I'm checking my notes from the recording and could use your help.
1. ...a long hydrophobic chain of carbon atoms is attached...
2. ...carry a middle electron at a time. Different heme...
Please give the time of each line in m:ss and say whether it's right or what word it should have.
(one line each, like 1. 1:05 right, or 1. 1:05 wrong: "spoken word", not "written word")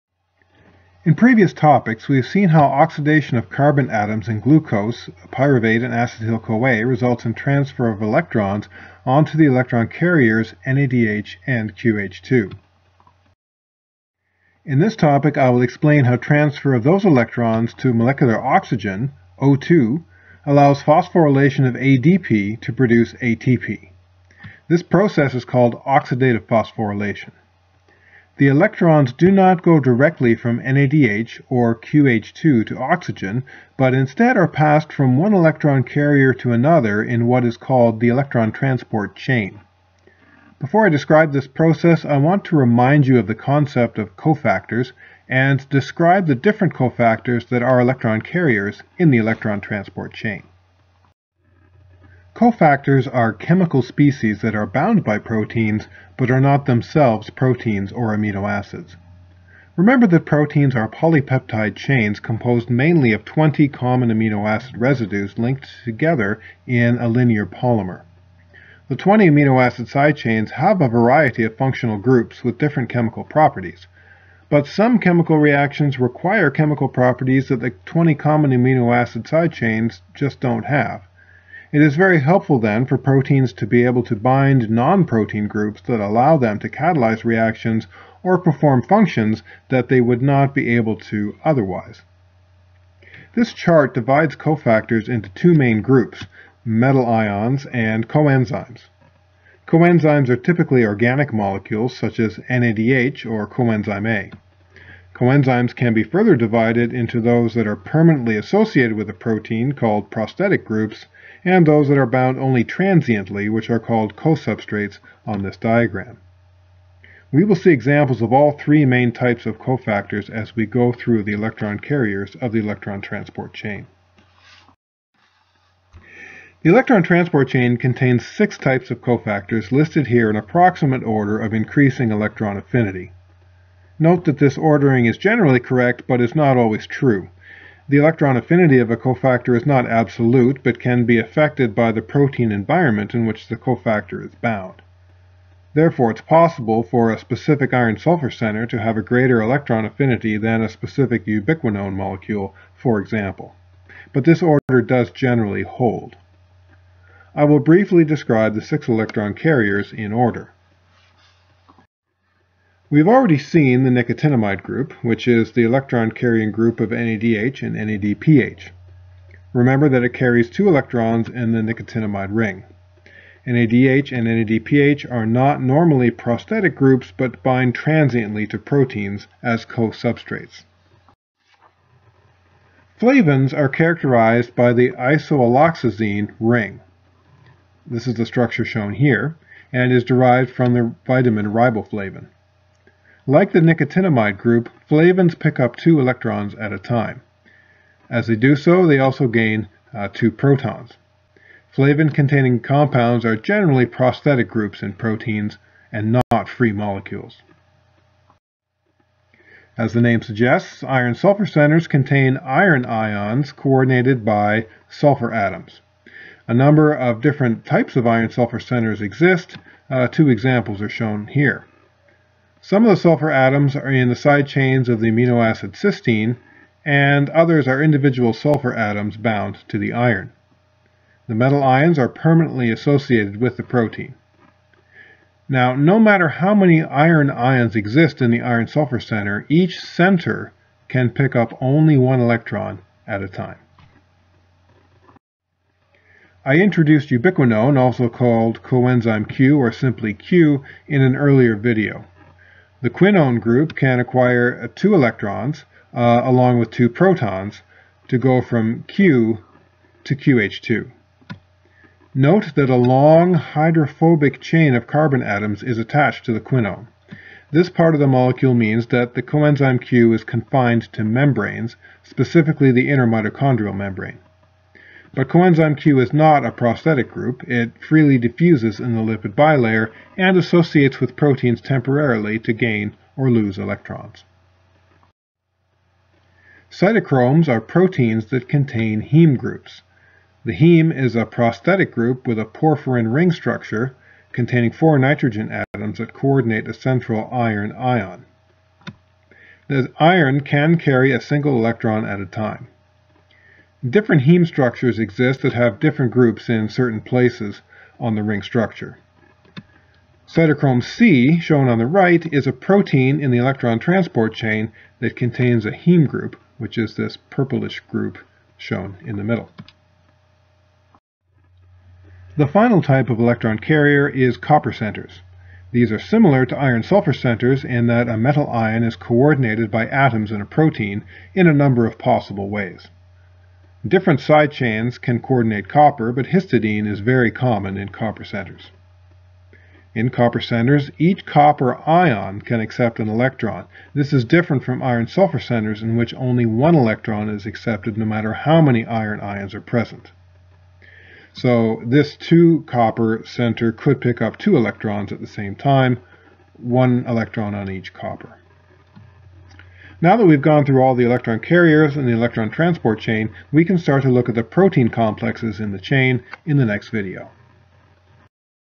1. 4:22 right
2. 5:00 wrong: "single", not "middle".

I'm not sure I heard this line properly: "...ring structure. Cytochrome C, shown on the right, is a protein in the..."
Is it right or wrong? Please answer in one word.
right.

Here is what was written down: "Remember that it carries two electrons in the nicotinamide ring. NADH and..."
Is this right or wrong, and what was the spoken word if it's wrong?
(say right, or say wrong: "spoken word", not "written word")
right.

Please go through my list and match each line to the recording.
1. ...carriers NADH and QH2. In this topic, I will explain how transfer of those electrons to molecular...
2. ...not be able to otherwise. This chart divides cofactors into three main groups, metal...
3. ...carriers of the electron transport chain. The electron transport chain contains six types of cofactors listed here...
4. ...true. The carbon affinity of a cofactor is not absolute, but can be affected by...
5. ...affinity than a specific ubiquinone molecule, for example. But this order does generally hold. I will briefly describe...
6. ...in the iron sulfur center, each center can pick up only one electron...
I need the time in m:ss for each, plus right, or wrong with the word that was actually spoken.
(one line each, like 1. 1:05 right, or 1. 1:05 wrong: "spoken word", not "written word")
1. 0:09 right
2. 1:30 wrong: "two", not "three"
3. 2:01 right
4. 2:16 wrong: "electron", not "carbon"
5. 2:29 right
6. 3:58 right.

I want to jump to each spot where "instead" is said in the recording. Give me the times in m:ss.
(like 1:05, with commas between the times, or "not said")
0:33.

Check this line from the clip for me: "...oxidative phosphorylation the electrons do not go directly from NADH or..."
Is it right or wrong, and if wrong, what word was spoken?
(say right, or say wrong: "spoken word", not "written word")
right.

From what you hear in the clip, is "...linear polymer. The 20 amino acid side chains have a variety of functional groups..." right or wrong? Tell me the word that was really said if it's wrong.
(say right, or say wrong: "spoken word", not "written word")
right.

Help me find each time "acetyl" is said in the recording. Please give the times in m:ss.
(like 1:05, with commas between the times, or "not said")
0:05.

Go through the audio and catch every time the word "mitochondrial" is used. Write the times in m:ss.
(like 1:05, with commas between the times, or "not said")
4:33.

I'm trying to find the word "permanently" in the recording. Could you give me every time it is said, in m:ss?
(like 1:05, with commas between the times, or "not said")
1:47, 3:52.